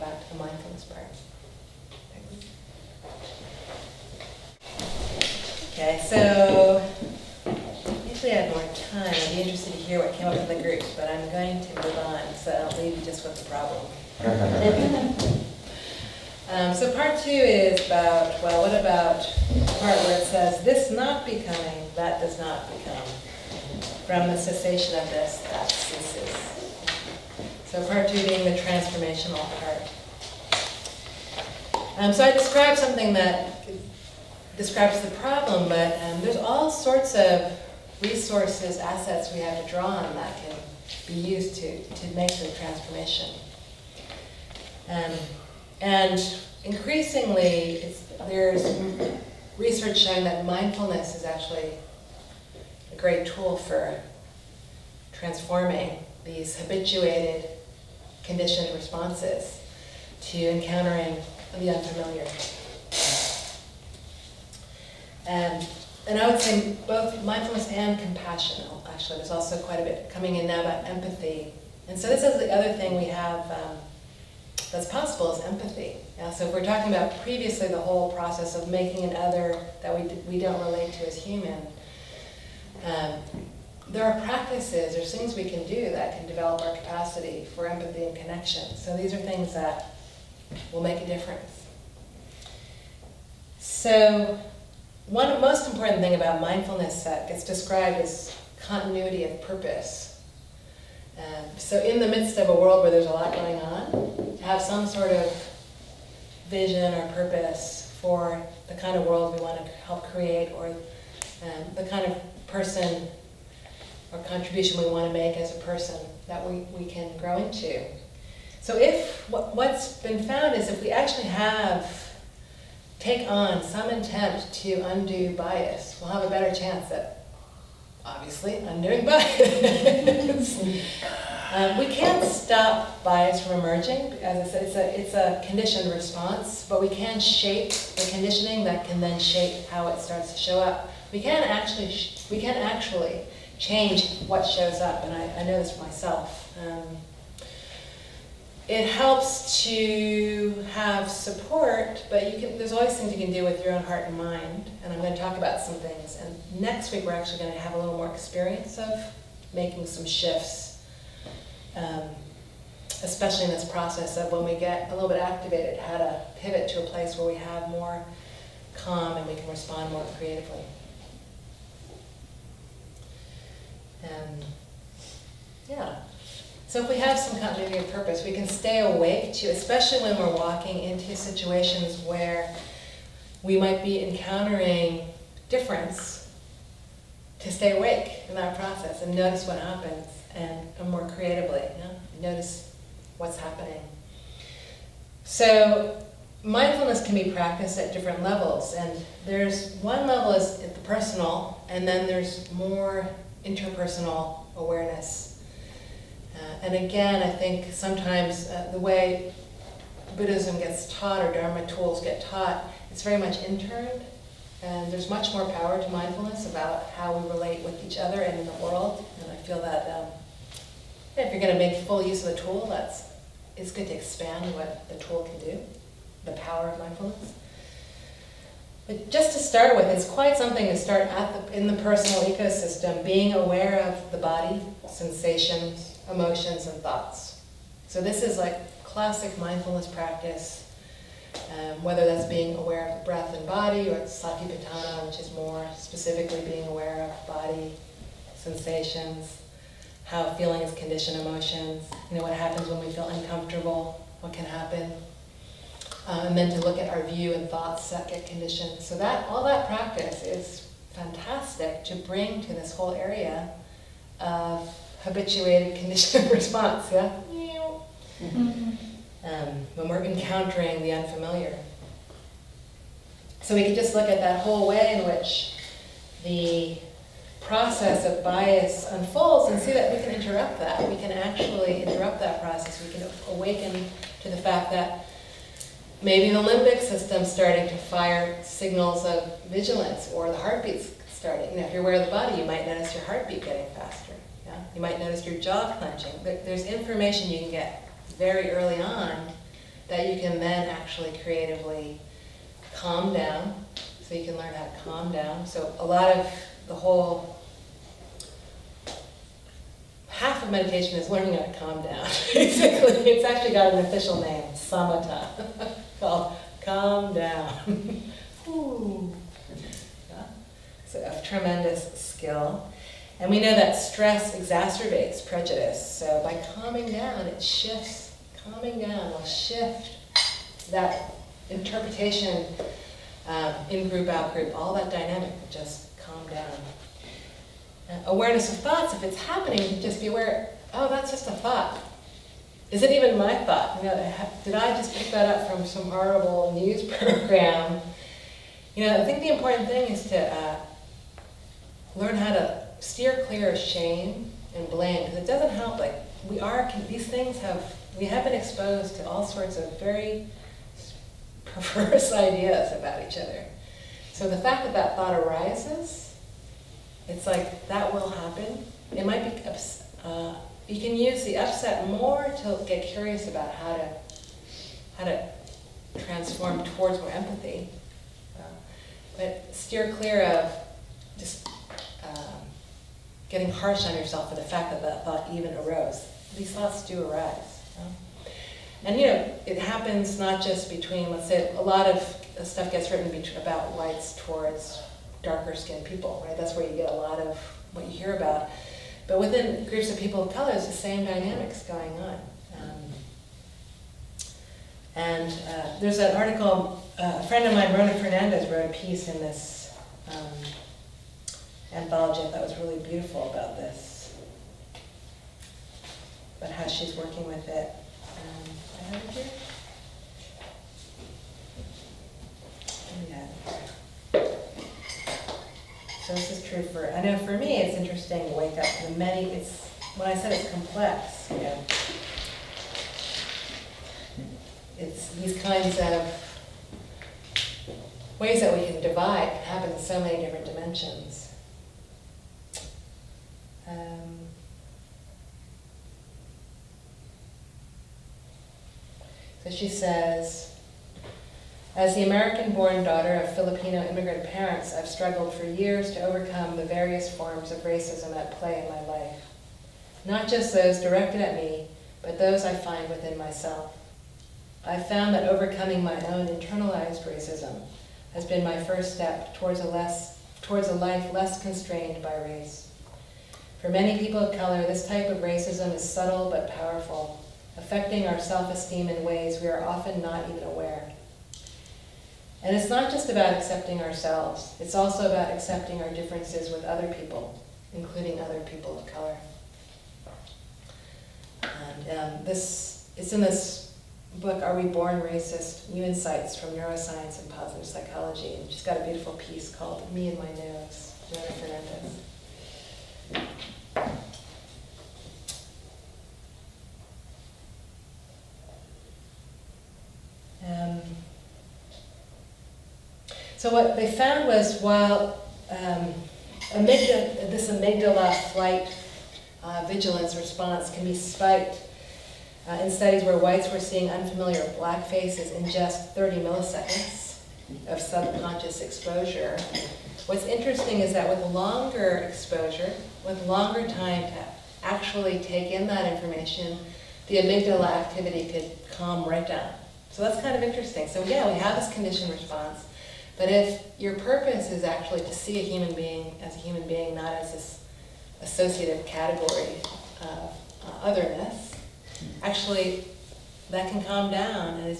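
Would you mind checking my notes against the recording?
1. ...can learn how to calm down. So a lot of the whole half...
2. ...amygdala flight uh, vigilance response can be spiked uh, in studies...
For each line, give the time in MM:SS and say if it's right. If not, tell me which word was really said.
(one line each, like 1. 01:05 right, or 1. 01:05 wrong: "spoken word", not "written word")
1. 05:04 right
2. 08:37 right.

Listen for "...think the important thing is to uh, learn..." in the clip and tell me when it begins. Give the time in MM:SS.
05:49.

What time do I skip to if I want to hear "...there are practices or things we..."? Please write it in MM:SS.
01:23.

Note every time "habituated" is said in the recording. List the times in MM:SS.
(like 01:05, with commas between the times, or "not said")
00:56, 04:25.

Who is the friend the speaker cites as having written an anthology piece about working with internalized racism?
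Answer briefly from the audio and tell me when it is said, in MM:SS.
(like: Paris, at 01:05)
Rona Fernandez, at 06:47.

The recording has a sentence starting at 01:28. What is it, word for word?
So these are things that will make a difference.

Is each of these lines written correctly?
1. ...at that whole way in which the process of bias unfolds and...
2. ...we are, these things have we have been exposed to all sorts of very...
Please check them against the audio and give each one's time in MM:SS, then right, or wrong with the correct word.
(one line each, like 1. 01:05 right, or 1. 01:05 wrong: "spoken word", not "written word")
1. 04:34 right
2. 05:56 right.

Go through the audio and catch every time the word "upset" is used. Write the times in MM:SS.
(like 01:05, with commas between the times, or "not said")
06:11.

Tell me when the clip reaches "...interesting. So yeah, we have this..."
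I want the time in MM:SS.
09:00.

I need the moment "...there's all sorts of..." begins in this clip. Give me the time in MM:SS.
00:36.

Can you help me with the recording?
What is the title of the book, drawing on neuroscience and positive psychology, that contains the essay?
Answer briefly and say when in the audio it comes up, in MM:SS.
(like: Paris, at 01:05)
Are We Born Racist?, at 08:14.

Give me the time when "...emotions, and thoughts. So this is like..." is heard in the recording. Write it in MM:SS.
03:56.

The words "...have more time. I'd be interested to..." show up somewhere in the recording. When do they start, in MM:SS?
00:08.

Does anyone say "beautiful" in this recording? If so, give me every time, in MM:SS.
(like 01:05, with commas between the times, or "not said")
06:52, 08:18.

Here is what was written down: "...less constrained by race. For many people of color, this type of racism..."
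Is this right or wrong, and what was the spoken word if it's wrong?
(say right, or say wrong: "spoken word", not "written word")
right.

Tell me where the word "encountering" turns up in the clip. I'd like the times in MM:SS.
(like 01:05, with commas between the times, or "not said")
01:00, 03:04, 04:30.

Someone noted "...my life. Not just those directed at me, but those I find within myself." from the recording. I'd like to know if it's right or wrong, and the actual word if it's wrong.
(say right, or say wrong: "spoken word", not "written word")
right.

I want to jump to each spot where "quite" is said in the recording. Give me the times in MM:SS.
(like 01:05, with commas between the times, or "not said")
01:09, 03:50.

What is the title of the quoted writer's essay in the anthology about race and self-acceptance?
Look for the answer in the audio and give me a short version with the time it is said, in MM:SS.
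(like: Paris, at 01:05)
Me and My Nose, at 08:19.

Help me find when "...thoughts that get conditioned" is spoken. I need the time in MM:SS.
04:17.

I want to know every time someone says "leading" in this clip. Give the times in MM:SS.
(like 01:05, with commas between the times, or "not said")
not said.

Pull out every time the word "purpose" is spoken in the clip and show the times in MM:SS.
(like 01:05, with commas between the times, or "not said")
01:39, 01:47, 02:57, 09:03.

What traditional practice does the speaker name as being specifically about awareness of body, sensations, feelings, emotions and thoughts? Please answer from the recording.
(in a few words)
Satipatthana.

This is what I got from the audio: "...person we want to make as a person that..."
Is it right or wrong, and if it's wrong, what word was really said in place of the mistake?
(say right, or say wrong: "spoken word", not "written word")
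wrong: "contribution", not "person".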